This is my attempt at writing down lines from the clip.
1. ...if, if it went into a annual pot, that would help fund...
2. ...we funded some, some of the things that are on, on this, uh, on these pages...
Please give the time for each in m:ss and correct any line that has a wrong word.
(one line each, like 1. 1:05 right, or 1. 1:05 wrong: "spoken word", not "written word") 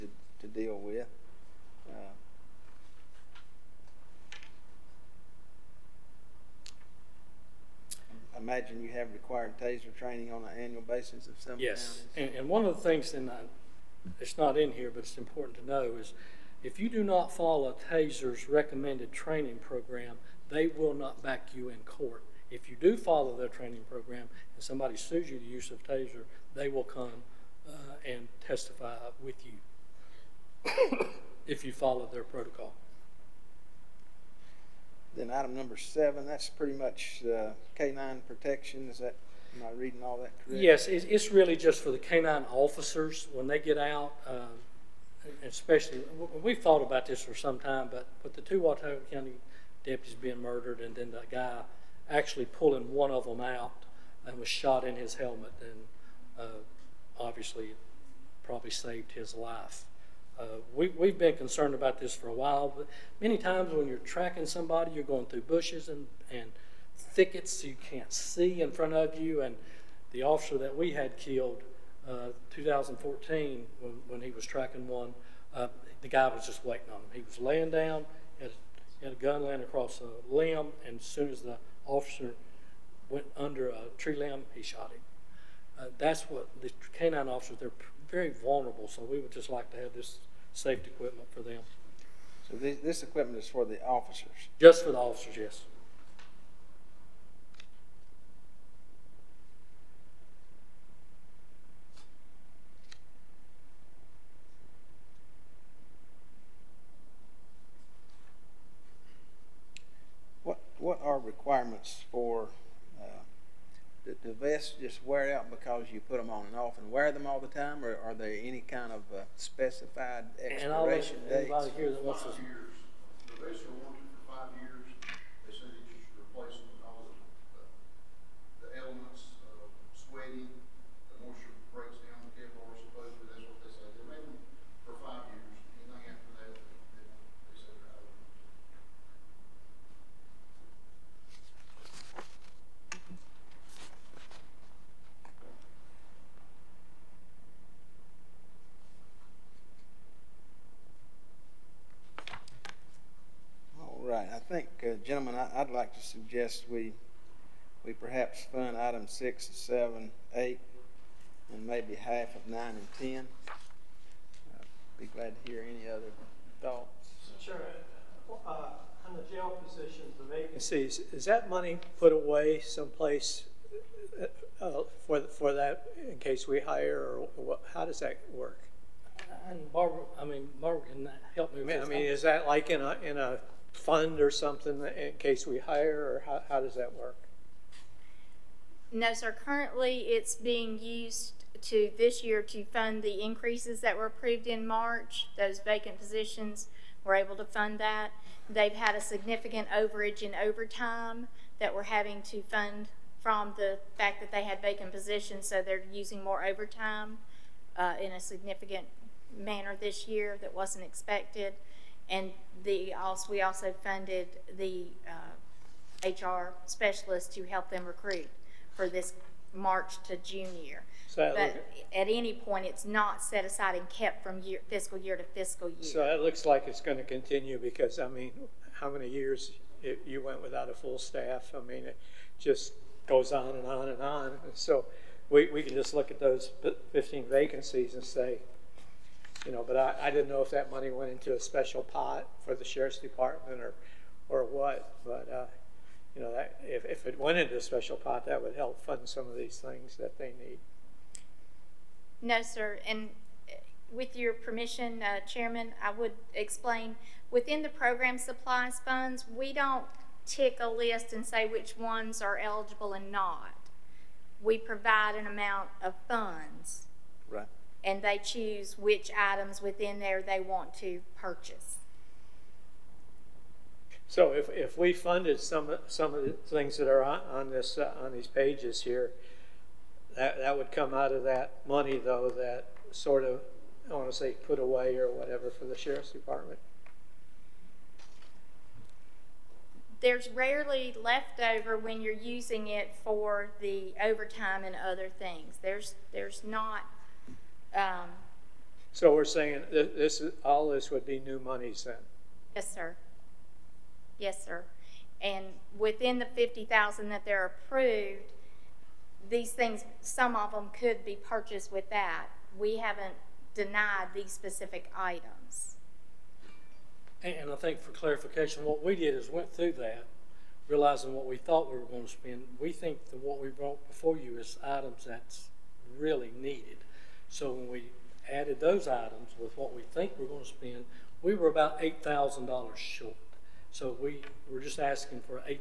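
1. 4:06 wrong: "special", not "annual"
2. 4:34 right.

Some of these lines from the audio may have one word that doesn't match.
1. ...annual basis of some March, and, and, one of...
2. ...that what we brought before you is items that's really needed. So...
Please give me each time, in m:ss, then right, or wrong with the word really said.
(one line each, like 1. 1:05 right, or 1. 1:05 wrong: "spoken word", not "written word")
1. 0:10 wrong: "Yes", not "March"
2. 5:23 right.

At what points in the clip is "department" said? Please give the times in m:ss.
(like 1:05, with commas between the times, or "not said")
4:02, 4:46.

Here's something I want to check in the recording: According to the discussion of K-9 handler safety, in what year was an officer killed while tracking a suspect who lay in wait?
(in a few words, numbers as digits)
2014.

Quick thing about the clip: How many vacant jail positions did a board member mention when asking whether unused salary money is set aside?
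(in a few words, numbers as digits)
15.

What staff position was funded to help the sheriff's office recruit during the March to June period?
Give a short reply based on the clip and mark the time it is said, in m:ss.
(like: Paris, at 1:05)
HR specialist, at 3:36.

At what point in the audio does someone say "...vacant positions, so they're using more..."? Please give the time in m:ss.
3:24.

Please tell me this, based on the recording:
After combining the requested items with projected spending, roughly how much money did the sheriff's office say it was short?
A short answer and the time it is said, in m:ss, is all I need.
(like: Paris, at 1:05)
$8,000, at 5:31.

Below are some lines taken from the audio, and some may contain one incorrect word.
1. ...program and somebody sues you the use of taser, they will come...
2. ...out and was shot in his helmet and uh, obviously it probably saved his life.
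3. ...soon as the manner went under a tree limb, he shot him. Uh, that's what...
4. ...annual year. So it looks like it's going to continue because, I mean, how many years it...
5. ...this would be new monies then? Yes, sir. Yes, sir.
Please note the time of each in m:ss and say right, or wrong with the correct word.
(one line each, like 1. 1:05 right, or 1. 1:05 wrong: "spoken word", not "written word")
1. 0:23 right
2. 0:53 right
3. 1:21 wrong: "officer", not "manner"
4. 3:45 wrong: "fiscal", not "annual"
5. 5:00 right.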